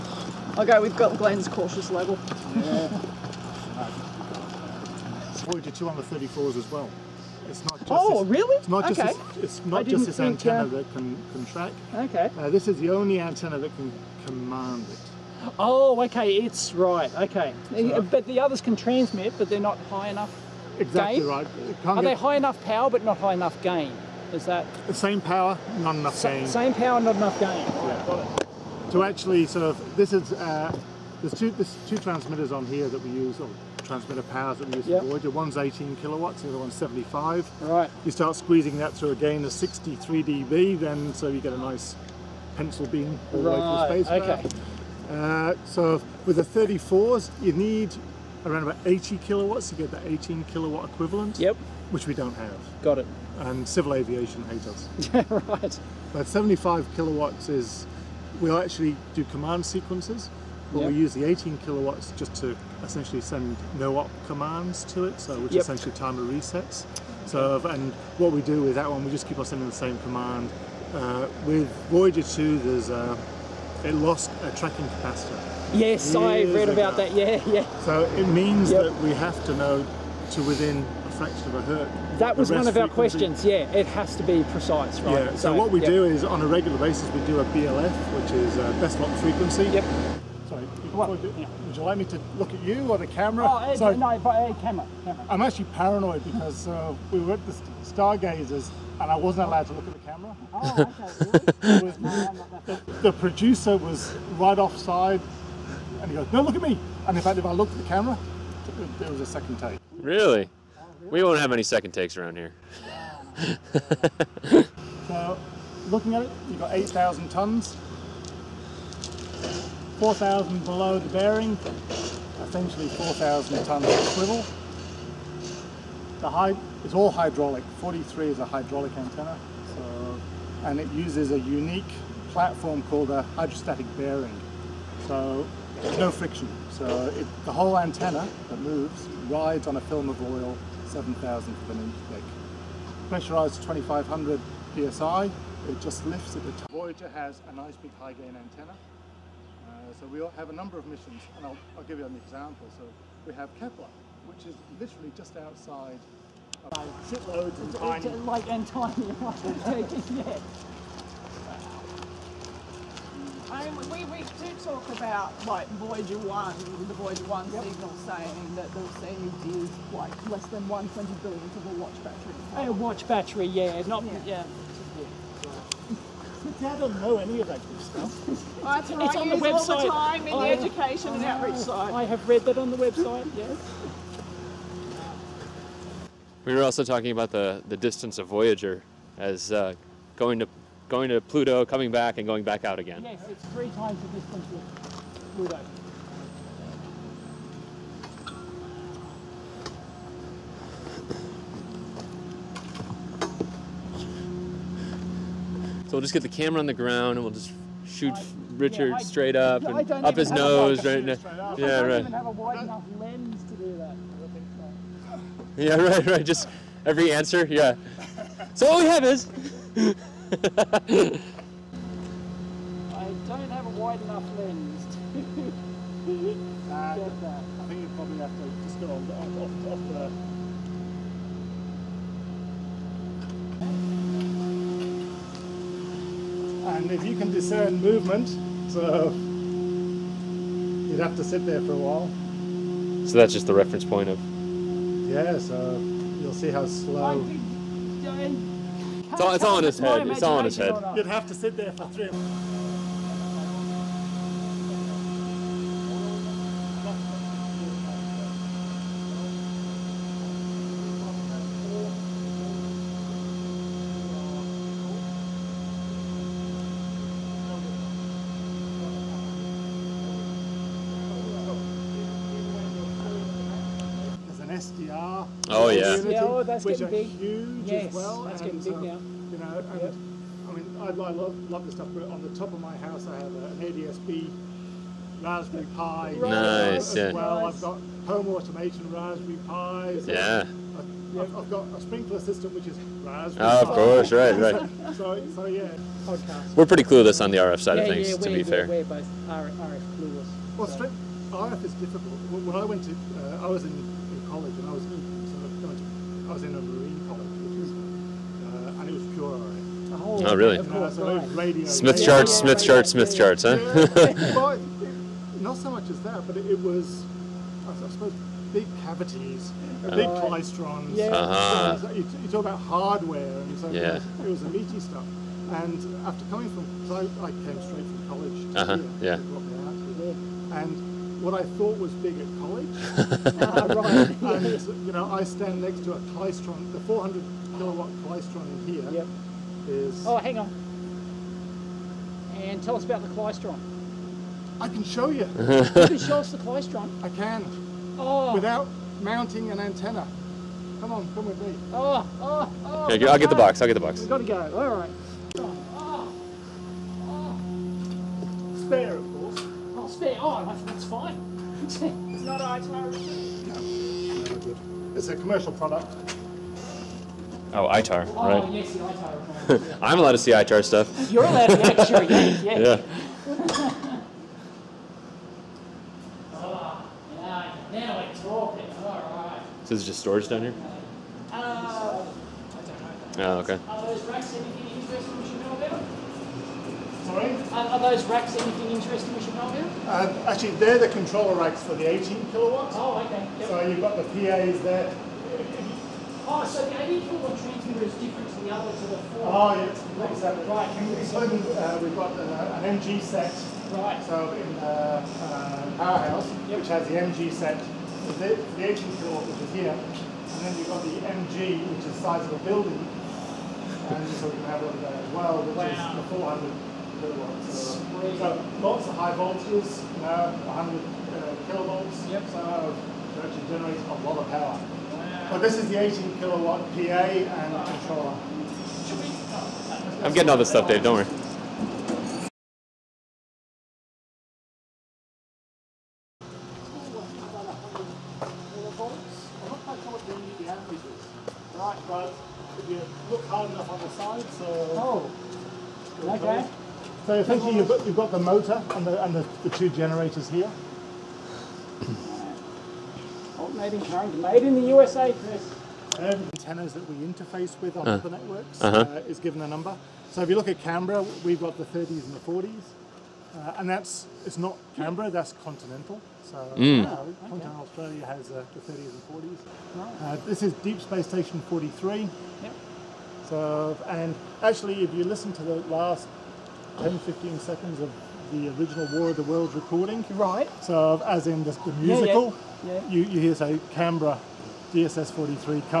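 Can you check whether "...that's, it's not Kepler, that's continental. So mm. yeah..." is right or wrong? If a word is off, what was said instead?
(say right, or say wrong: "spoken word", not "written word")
wrong: "Canberra", not "Kepler".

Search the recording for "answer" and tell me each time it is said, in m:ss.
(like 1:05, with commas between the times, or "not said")
3:37.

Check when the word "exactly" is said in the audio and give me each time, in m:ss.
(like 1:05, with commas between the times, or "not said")
0:20, 6:40.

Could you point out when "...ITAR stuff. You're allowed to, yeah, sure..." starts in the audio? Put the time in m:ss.
6:10.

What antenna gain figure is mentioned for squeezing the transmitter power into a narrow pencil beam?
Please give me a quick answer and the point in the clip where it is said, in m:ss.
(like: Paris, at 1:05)
63 dB, at 0:39.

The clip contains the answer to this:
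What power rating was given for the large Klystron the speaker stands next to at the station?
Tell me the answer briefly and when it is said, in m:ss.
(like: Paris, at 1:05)
400 kilowatts, at 5:36.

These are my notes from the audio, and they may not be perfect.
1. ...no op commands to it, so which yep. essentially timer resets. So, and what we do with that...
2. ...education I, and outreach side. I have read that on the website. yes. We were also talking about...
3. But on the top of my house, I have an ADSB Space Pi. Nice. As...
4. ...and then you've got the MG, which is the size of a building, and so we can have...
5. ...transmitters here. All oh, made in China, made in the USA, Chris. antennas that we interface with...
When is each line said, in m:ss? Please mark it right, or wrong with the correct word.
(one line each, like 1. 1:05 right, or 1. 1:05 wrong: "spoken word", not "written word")
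1. 1:03 right
2. 3:00 right
3. 4:41 wrong: "Raspberry", not "Space"
4. 6:49 right
5. 7:29 wrong: "generators", not "transmitters".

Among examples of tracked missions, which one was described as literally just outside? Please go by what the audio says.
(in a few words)
Kepler.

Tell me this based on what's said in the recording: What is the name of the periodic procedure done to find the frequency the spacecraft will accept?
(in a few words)
Best lock frequency.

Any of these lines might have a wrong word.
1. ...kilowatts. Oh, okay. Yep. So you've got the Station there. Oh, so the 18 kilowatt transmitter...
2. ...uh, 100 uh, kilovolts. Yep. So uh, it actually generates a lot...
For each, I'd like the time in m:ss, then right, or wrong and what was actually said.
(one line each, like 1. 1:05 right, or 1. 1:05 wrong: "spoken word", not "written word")
1. 6:32 wrong: "PAs", not "Station"
2. 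7:00 right.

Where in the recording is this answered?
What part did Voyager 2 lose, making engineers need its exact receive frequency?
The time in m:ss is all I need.
1:14.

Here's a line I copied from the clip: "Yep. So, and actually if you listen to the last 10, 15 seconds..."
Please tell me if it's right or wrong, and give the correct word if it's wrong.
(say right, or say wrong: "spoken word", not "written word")
right.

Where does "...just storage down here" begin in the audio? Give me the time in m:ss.
6:19.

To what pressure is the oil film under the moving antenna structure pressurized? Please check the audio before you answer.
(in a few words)
2500 psi.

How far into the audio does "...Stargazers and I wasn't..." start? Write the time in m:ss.
1:37.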